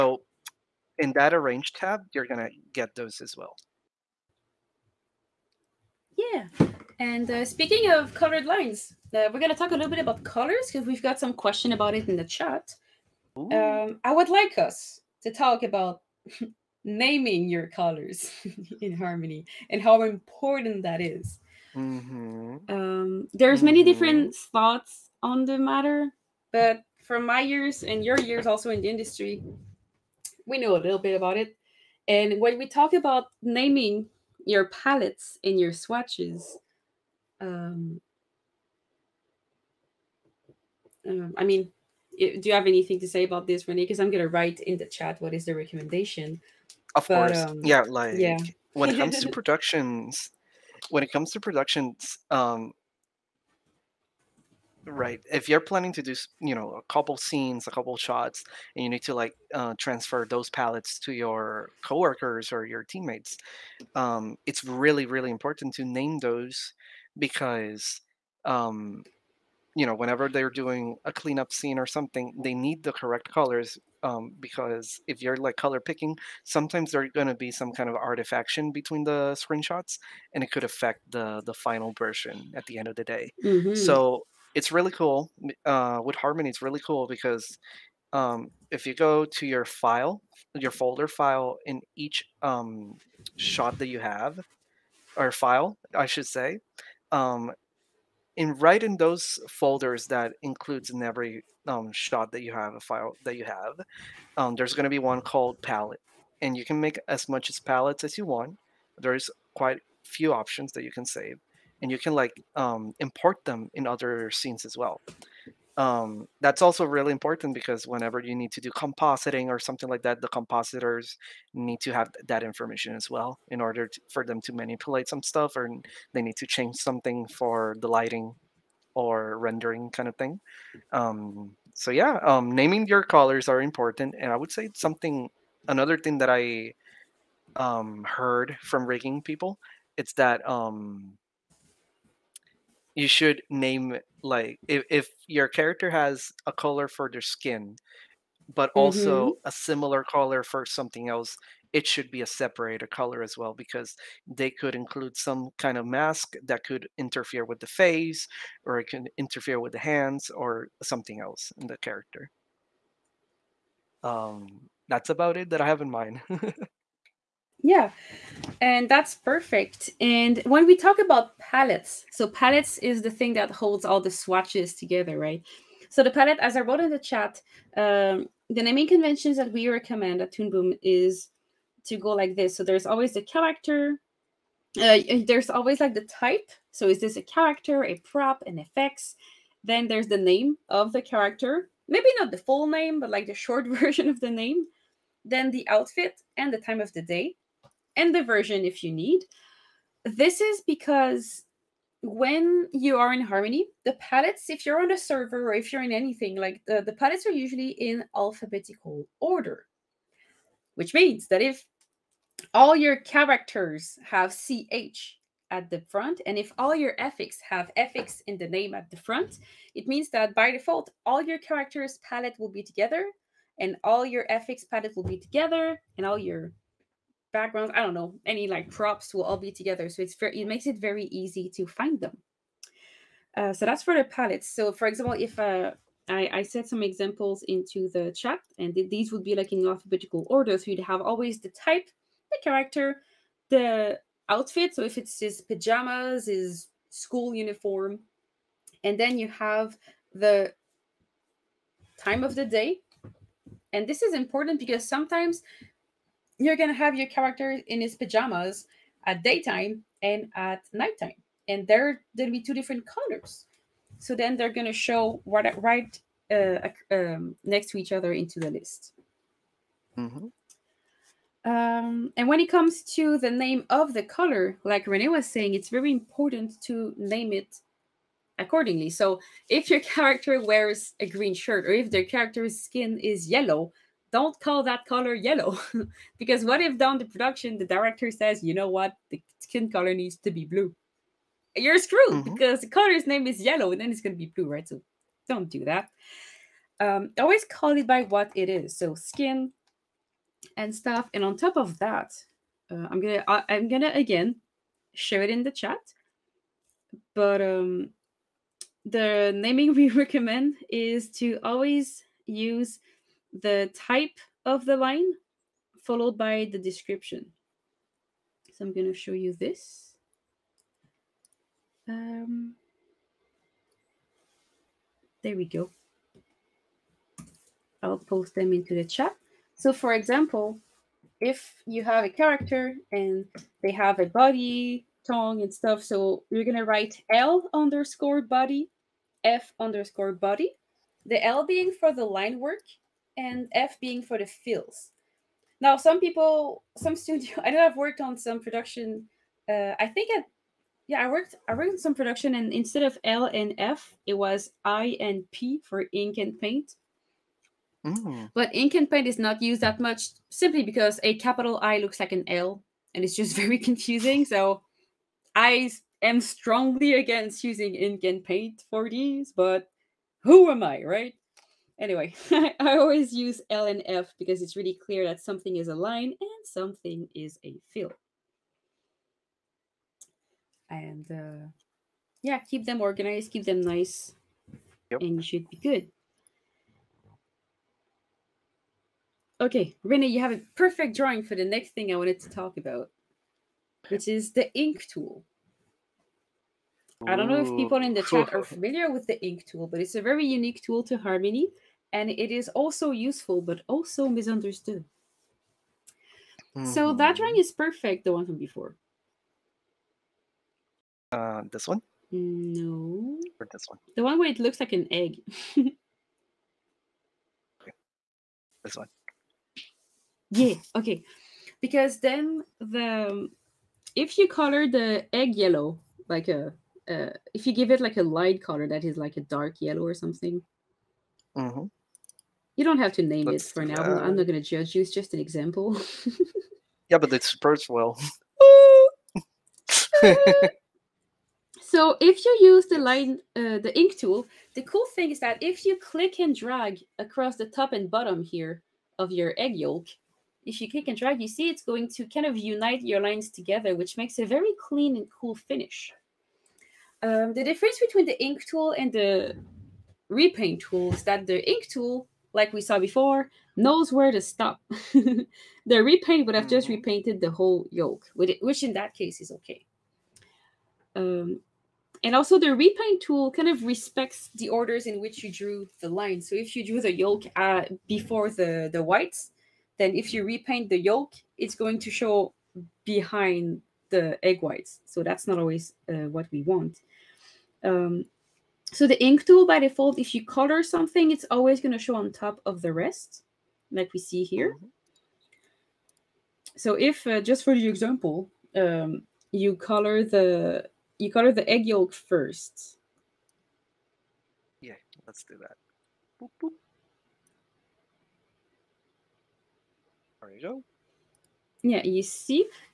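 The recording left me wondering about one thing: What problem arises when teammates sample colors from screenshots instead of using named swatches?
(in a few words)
artifaction.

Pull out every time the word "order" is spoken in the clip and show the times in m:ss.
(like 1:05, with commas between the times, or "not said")
2:03, 3:29, 4:00, 7:54.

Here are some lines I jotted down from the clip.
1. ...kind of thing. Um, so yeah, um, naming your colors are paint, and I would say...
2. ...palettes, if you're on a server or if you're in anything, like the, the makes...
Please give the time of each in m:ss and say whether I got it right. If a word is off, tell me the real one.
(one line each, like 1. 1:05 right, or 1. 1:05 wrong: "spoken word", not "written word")
1. 2:09 wrong: "important", not "paint"
2. 3:23 wrong: "palettes", not "makes".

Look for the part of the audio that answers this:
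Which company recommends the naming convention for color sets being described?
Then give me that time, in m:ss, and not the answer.
3:00.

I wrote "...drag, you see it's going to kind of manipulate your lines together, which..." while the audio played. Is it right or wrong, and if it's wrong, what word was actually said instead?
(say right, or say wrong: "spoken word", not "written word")
wrong: "unite", not "manipulate".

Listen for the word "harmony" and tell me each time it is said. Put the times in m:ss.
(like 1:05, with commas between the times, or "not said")
0:18, 1:26, 3:23, 6:40.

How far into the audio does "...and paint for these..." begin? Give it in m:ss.
6:08.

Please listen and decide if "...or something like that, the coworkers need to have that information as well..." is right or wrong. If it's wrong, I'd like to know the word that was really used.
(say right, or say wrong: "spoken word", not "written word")
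wrong: "compositors", not "coworkers".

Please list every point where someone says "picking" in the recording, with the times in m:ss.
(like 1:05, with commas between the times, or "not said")
1:15.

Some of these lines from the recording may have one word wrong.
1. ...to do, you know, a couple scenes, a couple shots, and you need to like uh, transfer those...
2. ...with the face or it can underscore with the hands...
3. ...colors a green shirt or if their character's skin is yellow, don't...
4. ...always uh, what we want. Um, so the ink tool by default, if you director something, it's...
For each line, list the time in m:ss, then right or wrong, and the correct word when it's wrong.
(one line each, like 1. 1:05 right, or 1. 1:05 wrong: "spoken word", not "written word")
1. 0:55 right
2. 2:37 wrong: "interfere", not "underscore"
3. 4:40 wrong: "wears", not "colors"
4. 8:05 wrong: "color", not "director".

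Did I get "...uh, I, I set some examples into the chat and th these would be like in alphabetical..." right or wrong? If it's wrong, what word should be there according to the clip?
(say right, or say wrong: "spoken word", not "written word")
right.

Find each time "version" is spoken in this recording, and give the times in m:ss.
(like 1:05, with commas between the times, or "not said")
1:21, 3:13, 3:18.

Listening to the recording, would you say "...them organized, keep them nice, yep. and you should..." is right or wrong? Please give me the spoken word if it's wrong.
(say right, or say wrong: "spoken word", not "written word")
right.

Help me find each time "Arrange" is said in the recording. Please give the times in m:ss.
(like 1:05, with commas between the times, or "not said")
0:01.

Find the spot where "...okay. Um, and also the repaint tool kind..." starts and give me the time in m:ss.
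7:49.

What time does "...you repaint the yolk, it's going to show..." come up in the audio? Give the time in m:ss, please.
8:00.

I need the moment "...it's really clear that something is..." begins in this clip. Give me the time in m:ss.
6:14.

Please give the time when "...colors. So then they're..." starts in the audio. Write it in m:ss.
4:22.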